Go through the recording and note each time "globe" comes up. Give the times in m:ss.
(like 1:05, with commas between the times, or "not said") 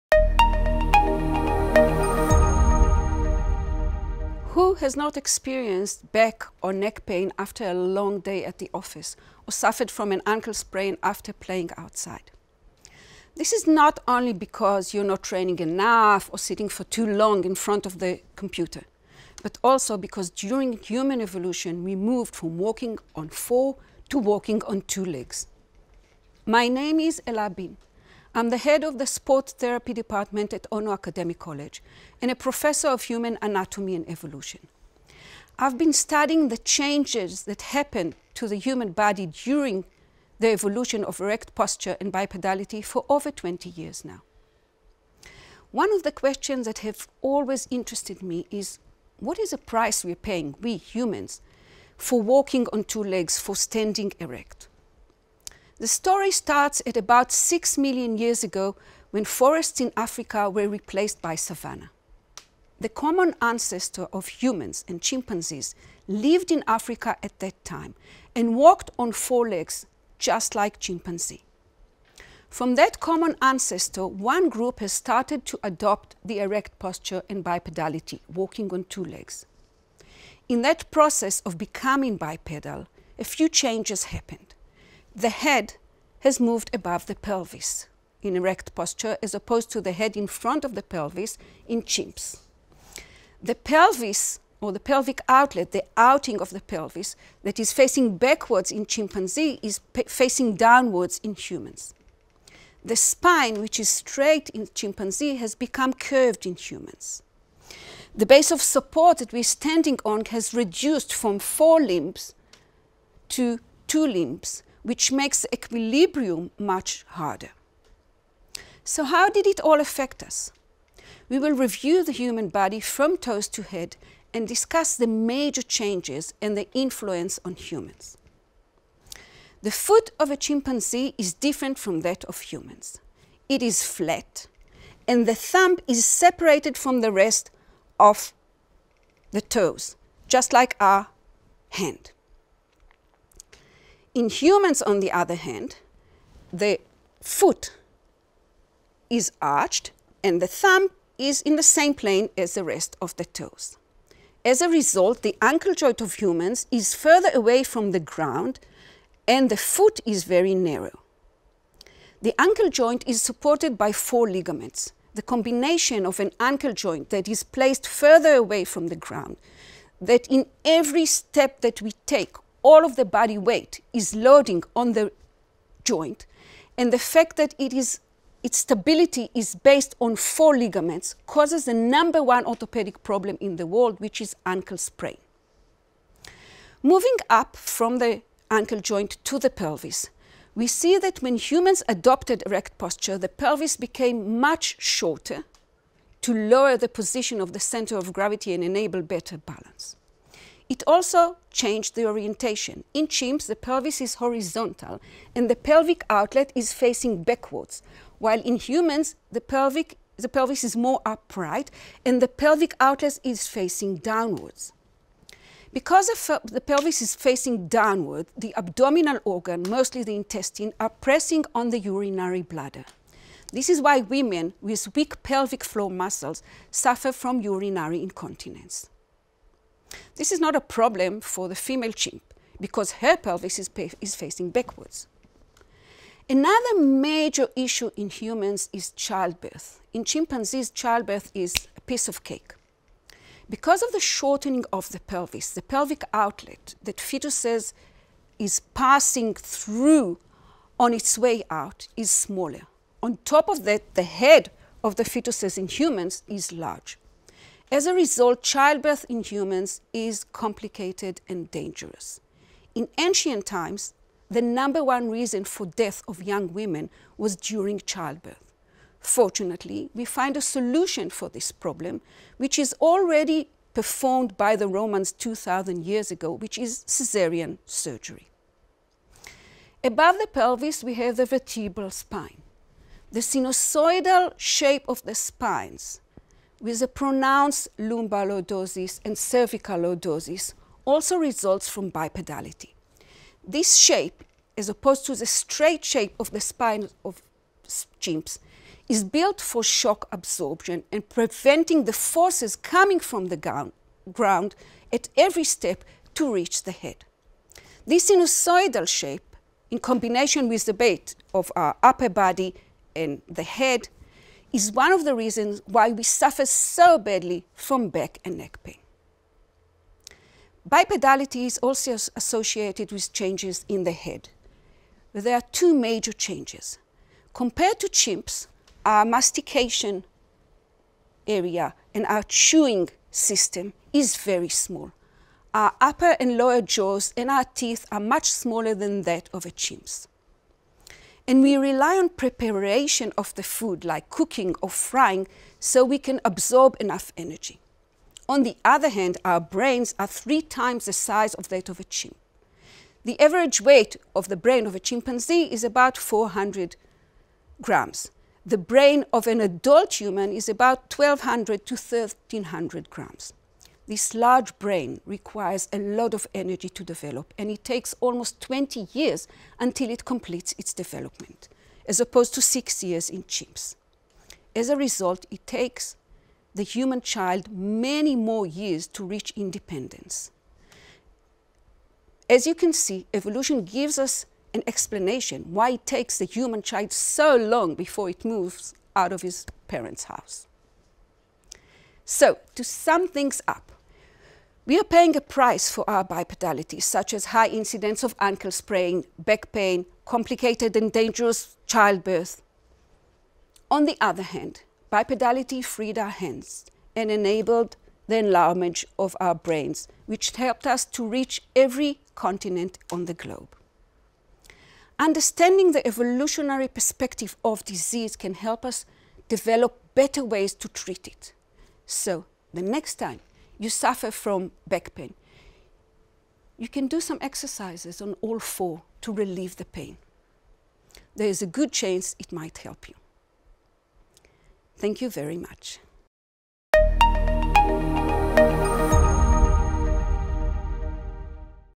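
6:53.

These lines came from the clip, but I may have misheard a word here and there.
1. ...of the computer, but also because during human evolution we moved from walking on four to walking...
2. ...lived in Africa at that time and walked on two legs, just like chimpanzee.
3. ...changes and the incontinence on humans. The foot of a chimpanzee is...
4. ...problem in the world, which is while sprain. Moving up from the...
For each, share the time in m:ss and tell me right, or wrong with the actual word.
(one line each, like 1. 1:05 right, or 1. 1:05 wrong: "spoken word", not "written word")
1. 0:17 right
2. 1:06 wrong: "four", not "two"
3. 2:05 wrong: "influence", not "incontinence"
4. 3:03 wrong: "ankle", not "while".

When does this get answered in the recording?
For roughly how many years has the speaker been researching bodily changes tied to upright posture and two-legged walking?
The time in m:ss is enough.
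0:43.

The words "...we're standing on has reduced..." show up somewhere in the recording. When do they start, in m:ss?
1:49.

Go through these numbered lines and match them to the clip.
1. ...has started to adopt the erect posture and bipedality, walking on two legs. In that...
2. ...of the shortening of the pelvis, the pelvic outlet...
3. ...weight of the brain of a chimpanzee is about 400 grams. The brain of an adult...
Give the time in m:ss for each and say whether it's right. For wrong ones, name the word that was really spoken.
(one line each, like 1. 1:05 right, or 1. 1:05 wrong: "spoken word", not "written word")
1. 1:14 right
2. 4:03 right
3. 5:53 right.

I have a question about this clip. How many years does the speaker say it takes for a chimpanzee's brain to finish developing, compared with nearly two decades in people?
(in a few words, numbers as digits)
6 years.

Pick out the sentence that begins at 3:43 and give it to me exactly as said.
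This is why women with weak pelvic floor muscles suffer from urinary incontinence.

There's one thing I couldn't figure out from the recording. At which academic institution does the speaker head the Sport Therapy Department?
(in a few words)
Ono Academic College.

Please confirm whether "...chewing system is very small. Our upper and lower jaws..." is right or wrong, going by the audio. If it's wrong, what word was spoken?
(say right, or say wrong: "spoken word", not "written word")
right.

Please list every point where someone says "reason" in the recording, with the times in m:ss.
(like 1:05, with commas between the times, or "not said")
4:25, 5:15.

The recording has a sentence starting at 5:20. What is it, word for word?
Bipedality is also associated with changes in the head.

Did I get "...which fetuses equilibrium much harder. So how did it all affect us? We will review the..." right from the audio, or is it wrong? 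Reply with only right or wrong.
wrong.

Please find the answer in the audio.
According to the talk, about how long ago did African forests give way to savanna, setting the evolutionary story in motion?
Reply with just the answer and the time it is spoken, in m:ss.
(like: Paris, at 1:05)
6 million years ago, at 0:57.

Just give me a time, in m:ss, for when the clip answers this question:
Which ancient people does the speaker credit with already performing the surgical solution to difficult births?
4:34.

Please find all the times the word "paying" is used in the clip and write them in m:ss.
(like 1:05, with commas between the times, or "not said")
0:50, 6:34.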